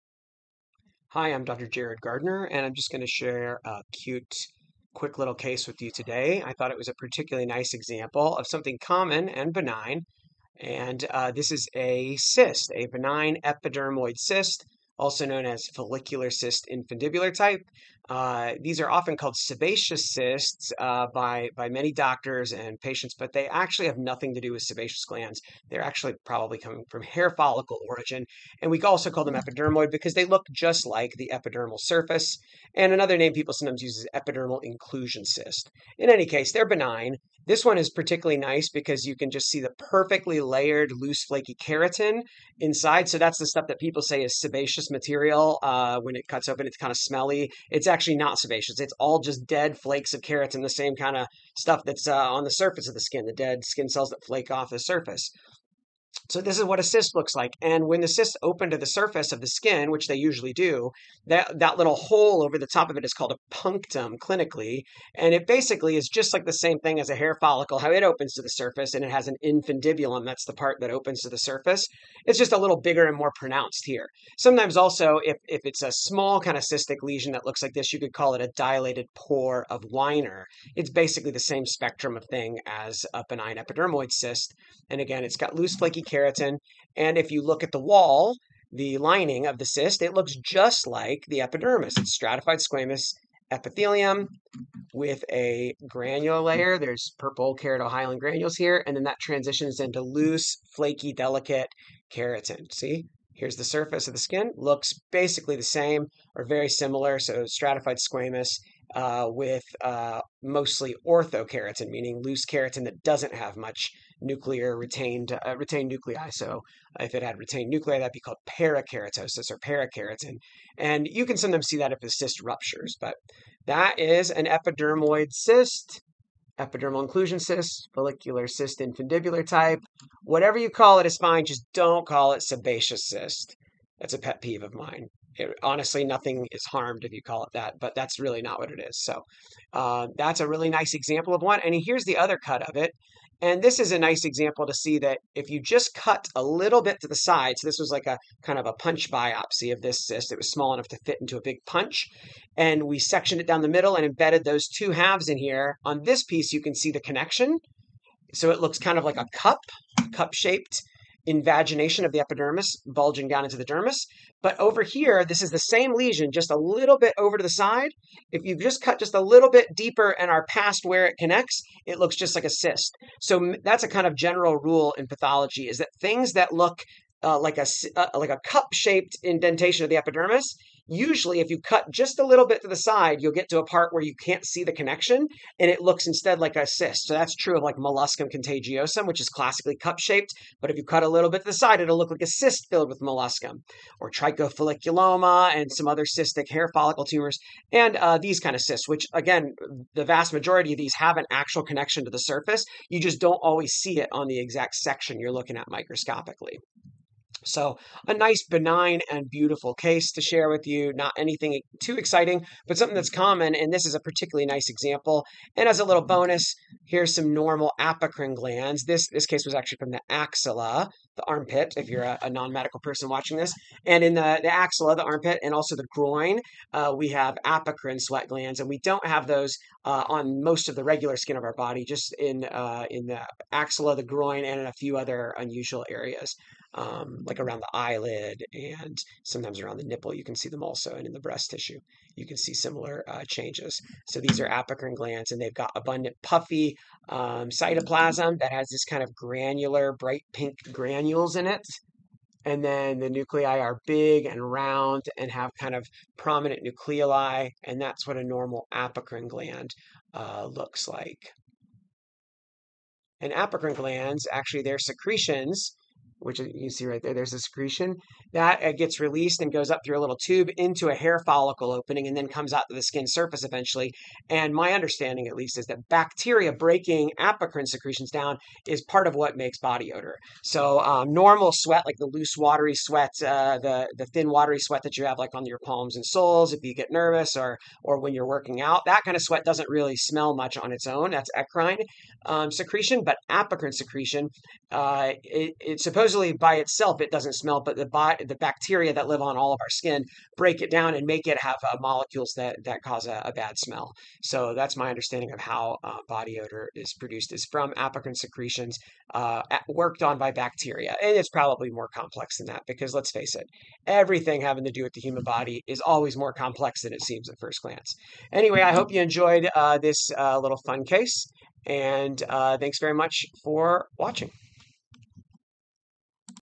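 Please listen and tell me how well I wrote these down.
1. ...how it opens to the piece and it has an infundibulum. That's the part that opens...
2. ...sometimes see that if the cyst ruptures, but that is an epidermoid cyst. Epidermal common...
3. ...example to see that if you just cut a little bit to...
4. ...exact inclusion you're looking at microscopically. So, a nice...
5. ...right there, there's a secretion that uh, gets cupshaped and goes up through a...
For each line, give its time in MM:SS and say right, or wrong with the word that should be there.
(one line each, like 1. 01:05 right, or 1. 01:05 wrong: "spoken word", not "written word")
1. 01:07 wrong: "surface", not "piece"
2. 02:01 wrong: "inclusion", not "common"
3. 02:24 right
4. 03:24 wrong: "section", not "inclusion"
5. 04:26 wrong: "released", not "cupshaped".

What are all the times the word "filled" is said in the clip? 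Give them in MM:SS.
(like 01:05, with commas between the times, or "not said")
03:12.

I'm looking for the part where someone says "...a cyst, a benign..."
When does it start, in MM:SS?
00:11.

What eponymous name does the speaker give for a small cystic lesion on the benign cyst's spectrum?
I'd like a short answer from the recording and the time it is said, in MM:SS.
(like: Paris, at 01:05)
dilated pore of Winer, at 01:18.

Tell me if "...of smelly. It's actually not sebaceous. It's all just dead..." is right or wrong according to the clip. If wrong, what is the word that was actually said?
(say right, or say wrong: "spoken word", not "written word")
right.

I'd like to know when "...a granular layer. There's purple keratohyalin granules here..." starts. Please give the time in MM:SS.
01:35.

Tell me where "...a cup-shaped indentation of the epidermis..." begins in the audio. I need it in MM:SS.
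02:58.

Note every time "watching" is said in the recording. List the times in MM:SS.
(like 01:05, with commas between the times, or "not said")
03:43, 05:23.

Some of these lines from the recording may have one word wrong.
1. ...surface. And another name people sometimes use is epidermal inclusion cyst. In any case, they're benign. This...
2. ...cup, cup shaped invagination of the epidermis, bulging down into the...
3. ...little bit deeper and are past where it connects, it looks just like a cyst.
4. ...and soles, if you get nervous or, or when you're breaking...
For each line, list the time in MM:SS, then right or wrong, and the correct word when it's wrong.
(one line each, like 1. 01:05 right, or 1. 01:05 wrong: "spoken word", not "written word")
1. 00:31 right
2. 02:39 right
3. 02:49 right
4. 04:45 wrong: "working", not "breaking".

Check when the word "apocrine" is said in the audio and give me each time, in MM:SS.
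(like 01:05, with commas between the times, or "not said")
03:37, 03:47, 04:04, 04:18, 04:23, 04:37, 04:53, 05:07.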